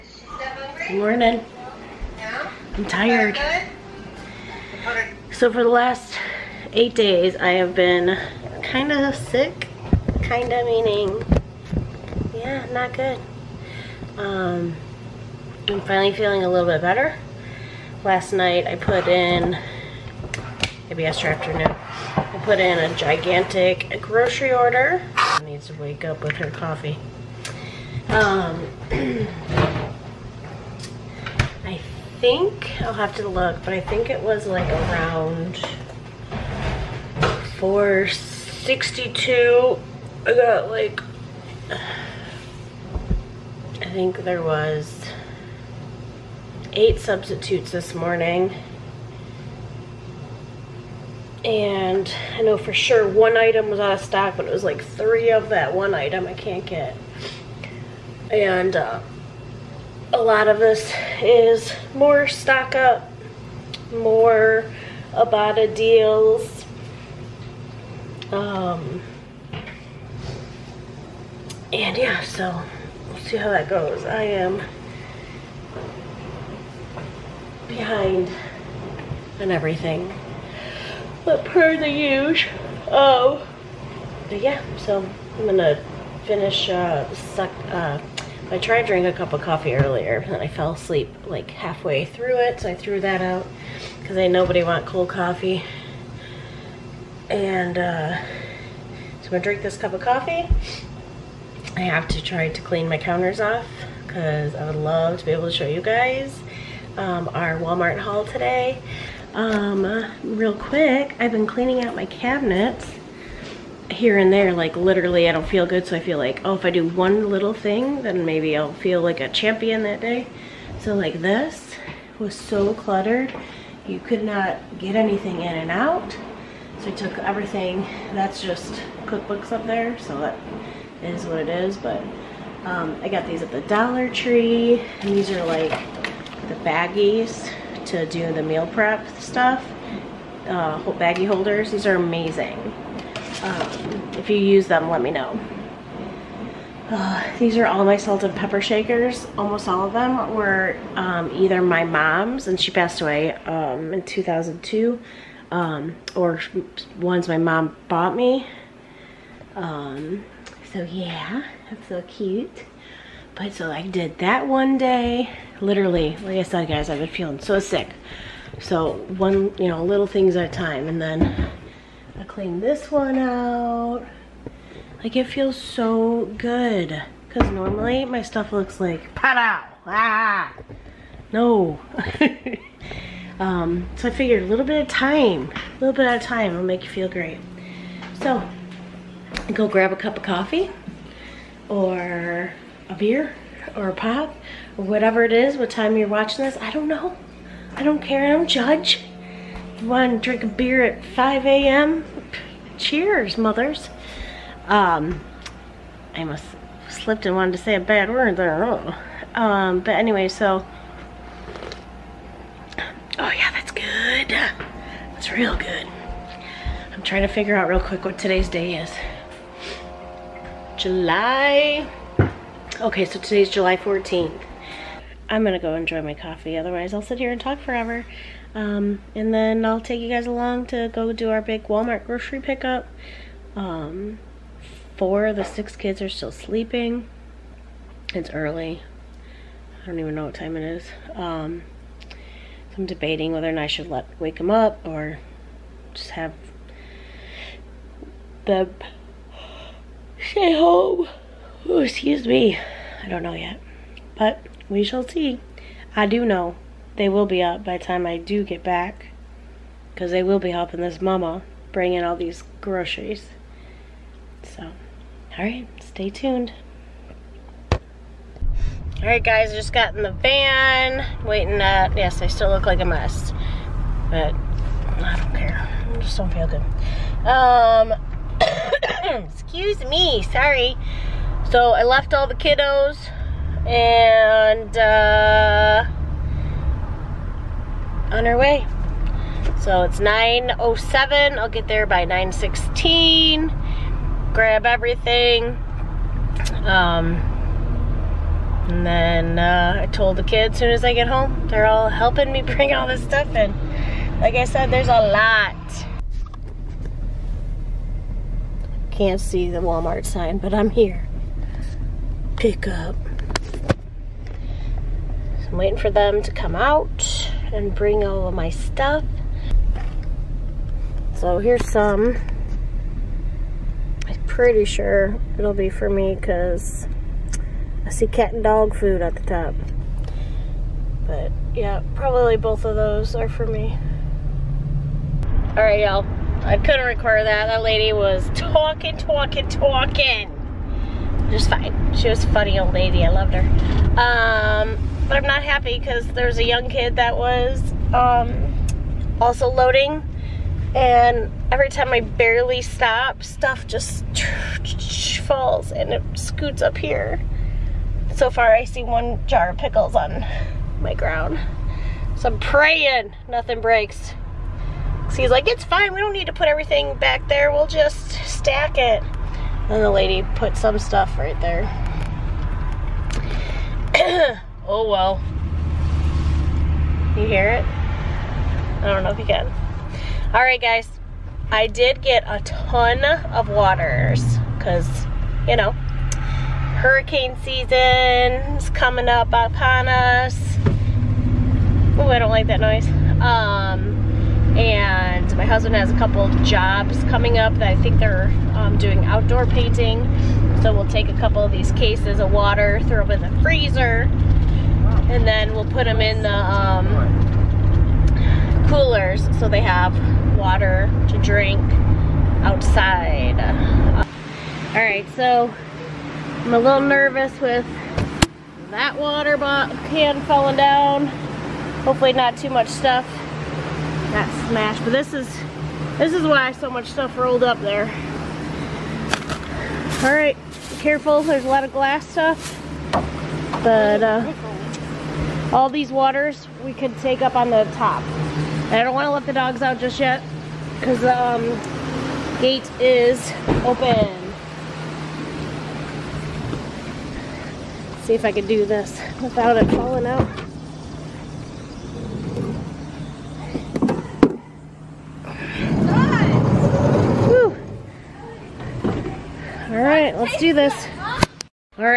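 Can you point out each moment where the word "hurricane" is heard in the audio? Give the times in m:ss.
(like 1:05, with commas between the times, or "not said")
6:26.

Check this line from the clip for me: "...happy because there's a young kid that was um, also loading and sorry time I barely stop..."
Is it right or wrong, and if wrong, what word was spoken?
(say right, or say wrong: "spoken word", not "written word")
wrong: "every", not "sorry".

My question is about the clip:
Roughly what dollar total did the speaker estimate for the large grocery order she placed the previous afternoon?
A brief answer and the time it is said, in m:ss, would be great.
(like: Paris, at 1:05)
462, at 0:37.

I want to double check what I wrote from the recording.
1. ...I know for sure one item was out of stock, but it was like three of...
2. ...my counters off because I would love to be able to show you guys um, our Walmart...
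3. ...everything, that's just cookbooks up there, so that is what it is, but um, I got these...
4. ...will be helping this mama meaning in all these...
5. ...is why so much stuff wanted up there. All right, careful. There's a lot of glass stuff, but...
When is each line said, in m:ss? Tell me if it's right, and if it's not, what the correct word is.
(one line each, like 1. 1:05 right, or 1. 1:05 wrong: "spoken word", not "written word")
1. 0:52 right
2. 1:42 right
3. 2:07 right
4. 4:20 wrong: "bring", not "meaning"
5. 7:06 wrong: "rolled", not "wanted".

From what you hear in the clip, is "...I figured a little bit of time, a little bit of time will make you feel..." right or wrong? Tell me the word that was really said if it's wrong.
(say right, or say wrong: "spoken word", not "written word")
right.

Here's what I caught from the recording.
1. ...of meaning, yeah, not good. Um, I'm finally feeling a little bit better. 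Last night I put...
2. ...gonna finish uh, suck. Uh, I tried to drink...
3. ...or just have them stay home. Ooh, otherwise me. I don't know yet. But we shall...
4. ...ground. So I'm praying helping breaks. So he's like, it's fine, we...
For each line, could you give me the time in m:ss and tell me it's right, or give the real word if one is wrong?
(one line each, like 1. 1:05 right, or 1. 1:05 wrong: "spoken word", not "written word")
1. 0:10 right
2. 1:25 right
3. 4:04 wrong: "excuse", not "otherwise"
4. 6:00 wrong: "nothing", not "helping".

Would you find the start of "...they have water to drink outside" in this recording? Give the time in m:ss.
6:49.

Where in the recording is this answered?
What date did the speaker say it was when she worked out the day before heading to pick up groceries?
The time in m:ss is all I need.
3:43.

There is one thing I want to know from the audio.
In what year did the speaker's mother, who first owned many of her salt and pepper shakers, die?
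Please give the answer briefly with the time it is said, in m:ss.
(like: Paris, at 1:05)
2002, at 2:34.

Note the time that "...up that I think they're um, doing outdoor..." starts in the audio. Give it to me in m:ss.
6:37.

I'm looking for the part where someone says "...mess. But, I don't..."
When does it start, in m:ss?
4:32.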